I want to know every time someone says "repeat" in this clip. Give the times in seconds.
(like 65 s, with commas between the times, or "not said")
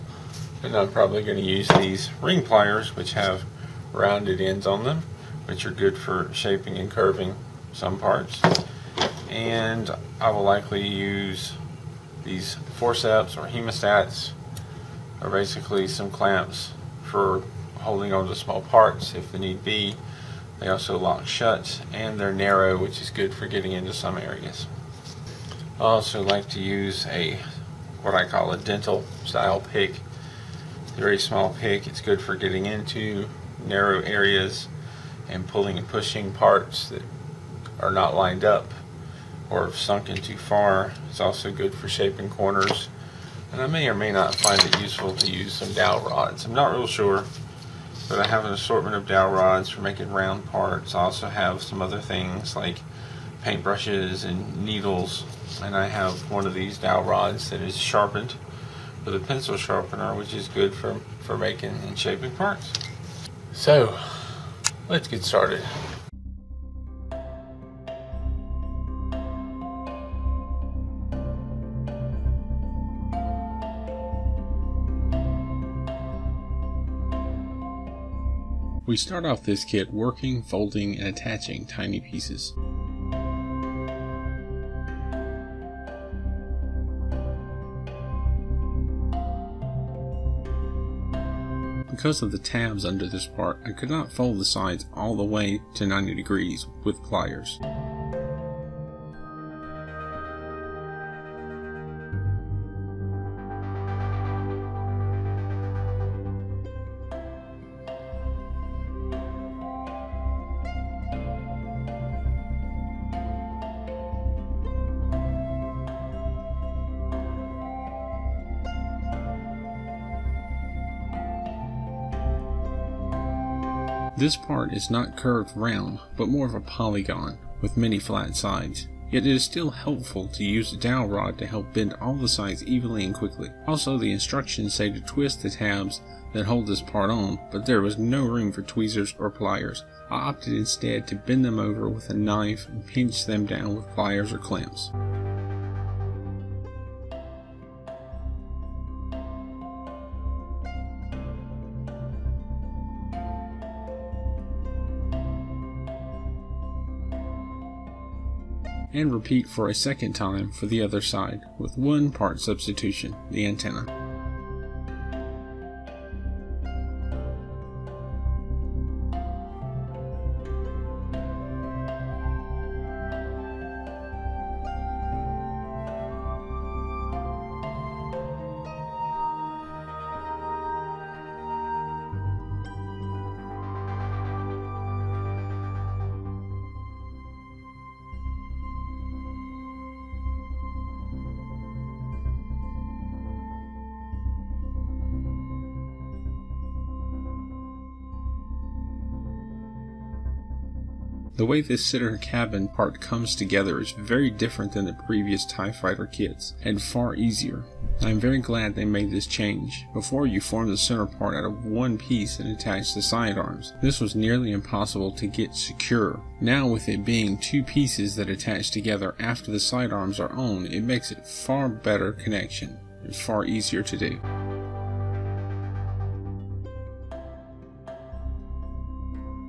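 159 s.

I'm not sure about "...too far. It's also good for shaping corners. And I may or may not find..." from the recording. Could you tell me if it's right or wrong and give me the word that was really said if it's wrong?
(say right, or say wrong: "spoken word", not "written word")
right.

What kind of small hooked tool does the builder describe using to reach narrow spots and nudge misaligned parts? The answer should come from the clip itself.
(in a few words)
dental style pick.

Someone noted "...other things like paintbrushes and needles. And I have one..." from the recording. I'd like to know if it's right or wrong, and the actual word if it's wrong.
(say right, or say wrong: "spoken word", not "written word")
right.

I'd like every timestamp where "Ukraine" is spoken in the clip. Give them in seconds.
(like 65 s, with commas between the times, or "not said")
not said.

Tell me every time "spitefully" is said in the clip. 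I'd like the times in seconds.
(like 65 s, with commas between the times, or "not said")
not said.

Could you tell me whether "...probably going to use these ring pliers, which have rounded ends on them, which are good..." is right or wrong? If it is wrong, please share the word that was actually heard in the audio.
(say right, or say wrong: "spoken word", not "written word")
right.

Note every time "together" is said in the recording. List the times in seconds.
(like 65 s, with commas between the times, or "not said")
203 s, 218 s.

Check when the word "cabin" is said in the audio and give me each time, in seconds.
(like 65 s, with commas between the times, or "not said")
202 s.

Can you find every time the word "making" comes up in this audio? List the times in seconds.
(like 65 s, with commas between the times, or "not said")
49 s, 61 s.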